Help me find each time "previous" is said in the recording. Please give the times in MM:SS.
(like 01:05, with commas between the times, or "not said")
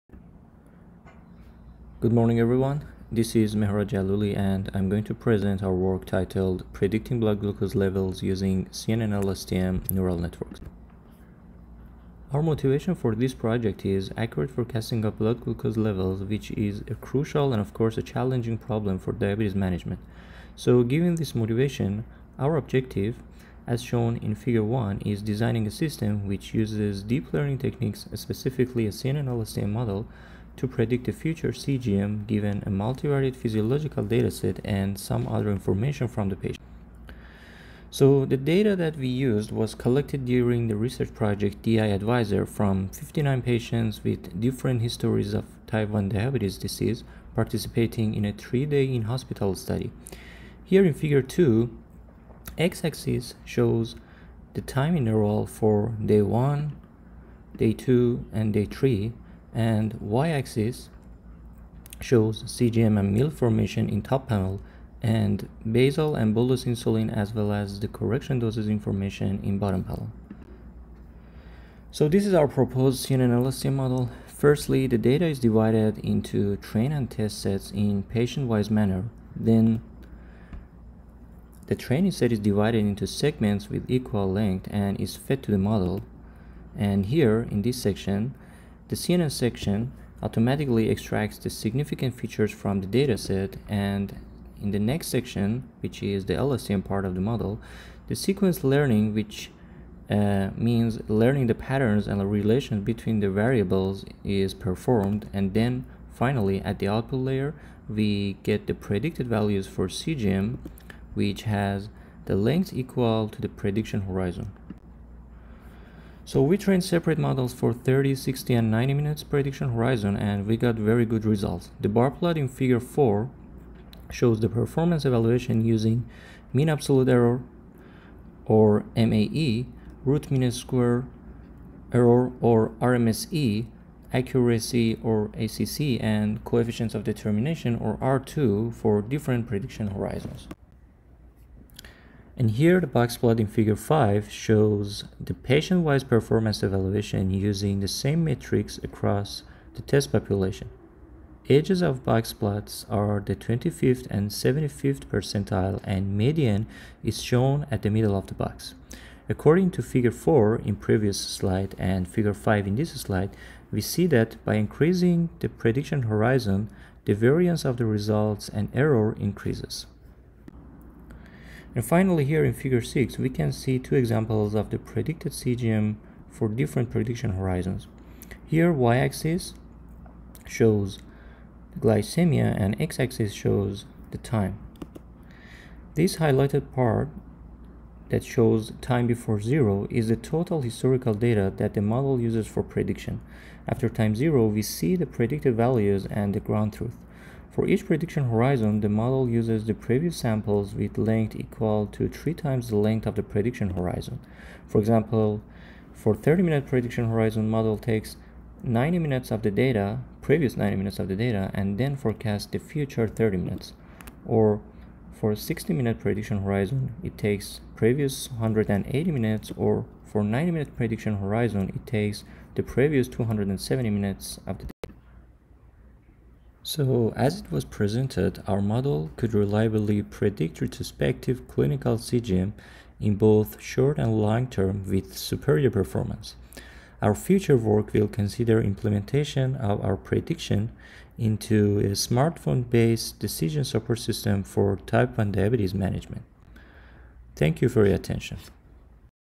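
02:40, 03:19, 03:30, 03:37, 03:42.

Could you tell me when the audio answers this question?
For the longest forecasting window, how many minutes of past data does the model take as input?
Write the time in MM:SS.
03:43.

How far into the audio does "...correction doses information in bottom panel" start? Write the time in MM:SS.
01:07.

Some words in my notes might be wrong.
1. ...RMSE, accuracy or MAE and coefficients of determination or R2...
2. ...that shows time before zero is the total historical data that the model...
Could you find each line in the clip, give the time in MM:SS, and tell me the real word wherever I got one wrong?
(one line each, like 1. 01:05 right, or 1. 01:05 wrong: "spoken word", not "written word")
1. 02:12 wrong: "ACC", not "MAE"
2. 03:08 right.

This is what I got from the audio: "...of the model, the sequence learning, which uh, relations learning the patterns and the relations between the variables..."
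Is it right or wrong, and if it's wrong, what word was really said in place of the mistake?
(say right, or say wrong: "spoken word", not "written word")
wrong: "means", not "relations".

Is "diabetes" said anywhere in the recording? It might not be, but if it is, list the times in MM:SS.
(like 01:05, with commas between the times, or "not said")
00:19, 00:46, 04:05.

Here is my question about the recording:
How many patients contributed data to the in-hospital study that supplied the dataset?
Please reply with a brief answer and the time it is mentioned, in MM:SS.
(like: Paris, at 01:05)
59, at 00:42.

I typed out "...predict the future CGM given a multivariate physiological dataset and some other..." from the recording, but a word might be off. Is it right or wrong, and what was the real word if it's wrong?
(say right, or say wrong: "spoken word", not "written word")
right.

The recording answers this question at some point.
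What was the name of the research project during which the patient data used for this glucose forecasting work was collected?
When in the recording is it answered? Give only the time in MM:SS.
00:41.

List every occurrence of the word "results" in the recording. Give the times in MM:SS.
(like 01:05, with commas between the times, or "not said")
02:01, 02:47.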